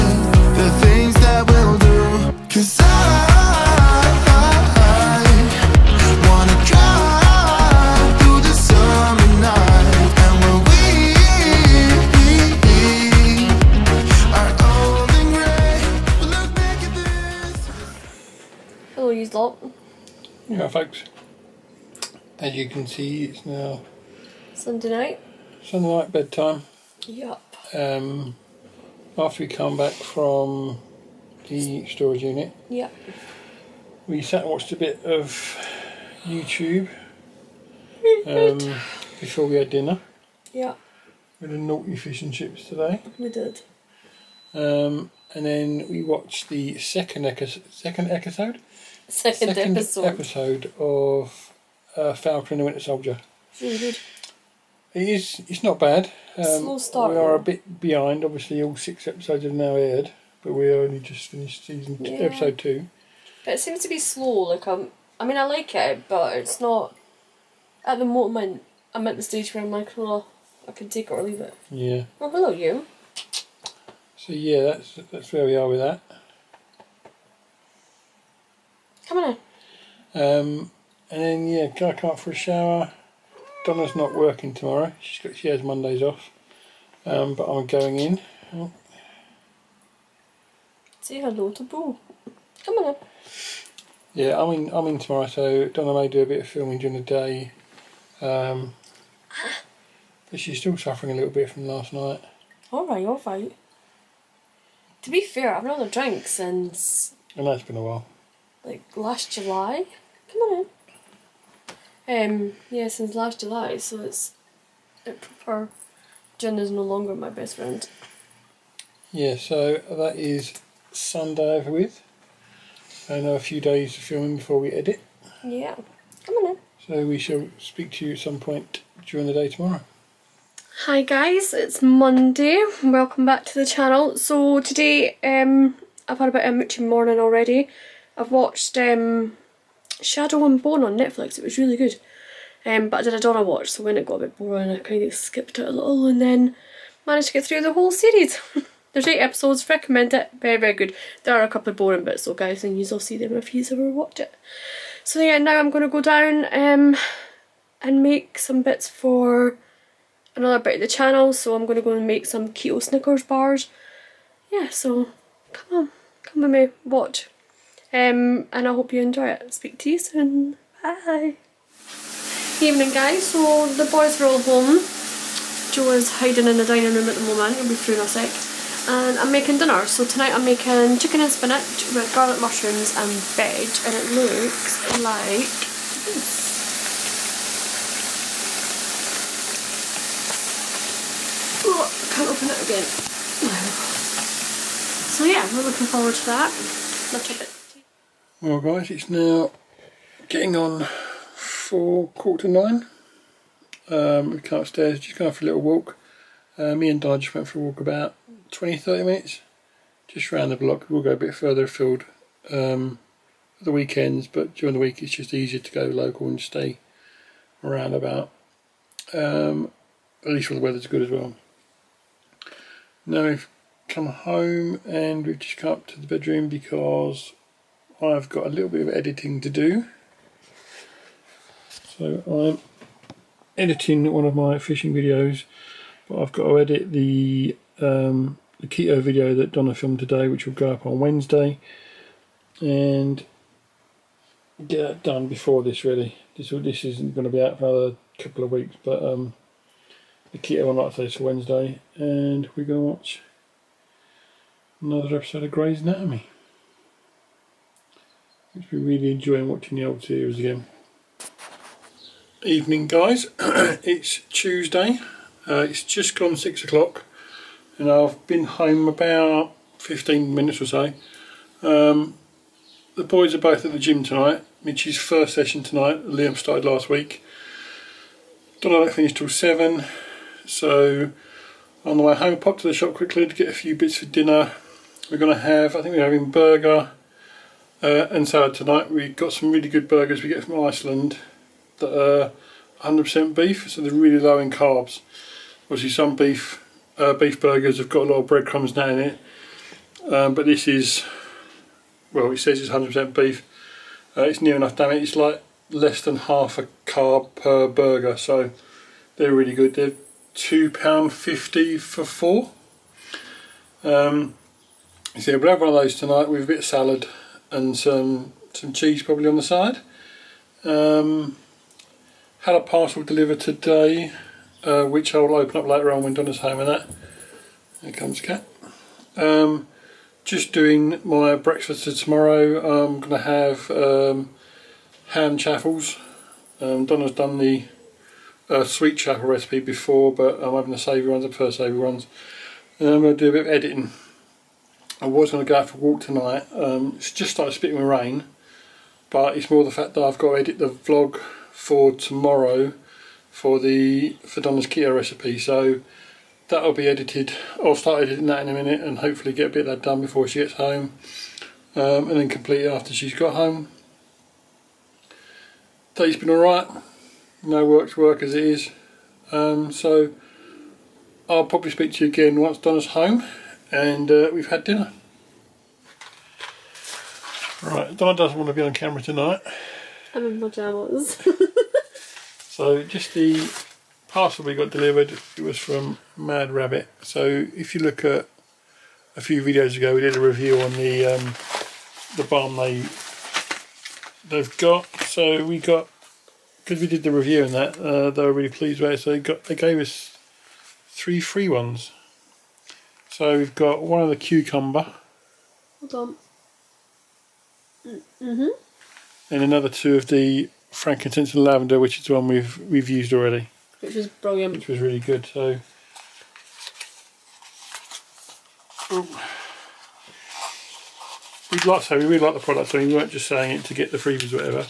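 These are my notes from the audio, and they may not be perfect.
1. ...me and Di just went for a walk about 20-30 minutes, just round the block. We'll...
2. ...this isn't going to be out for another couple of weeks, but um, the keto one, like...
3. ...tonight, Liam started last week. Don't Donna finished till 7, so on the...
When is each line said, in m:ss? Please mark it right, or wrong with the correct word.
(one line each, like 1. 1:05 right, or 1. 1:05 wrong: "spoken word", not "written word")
1. 3:26 right
2. 4:06 right
3. 4:35 right.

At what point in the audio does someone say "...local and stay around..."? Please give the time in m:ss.
3:35.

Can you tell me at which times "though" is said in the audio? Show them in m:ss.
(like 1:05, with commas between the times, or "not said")
2:32.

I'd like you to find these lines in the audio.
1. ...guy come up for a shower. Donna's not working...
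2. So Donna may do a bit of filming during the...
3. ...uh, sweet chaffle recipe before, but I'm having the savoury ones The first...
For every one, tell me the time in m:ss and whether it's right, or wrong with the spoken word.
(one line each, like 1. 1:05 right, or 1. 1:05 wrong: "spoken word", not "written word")
1. 1:21 right
2. 1:35 right
3. 5:38 right.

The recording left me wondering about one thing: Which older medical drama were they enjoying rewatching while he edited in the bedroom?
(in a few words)
Grey's Anatomy.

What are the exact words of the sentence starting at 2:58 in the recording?
And I'm making dinner, so tonight I'm making chicken and spinach with garlic mushrooms and veg, and it looks like this.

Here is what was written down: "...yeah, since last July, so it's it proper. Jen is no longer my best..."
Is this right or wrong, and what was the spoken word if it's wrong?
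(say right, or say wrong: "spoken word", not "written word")
right.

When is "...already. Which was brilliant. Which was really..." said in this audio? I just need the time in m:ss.
6:53.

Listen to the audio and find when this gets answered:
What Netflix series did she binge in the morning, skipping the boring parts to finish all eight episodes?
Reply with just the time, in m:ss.
2:20.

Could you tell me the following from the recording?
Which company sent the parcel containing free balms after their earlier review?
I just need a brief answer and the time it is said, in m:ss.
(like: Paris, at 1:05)
Mad Rabbit, at 6:26.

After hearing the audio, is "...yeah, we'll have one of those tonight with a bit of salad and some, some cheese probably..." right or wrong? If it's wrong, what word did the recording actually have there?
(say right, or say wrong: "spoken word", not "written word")
right.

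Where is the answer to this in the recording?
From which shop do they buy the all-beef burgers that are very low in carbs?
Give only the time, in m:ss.
4:50.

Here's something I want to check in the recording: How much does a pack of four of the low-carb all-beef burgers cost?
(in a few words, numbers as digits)
£2.50.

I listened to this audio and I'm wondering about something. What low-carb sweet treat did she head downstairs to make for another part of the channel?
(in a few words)
keto Snickers bars.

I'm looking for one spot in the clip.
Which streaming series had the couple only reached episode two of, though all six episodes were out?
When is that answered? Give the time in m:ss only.
0:52.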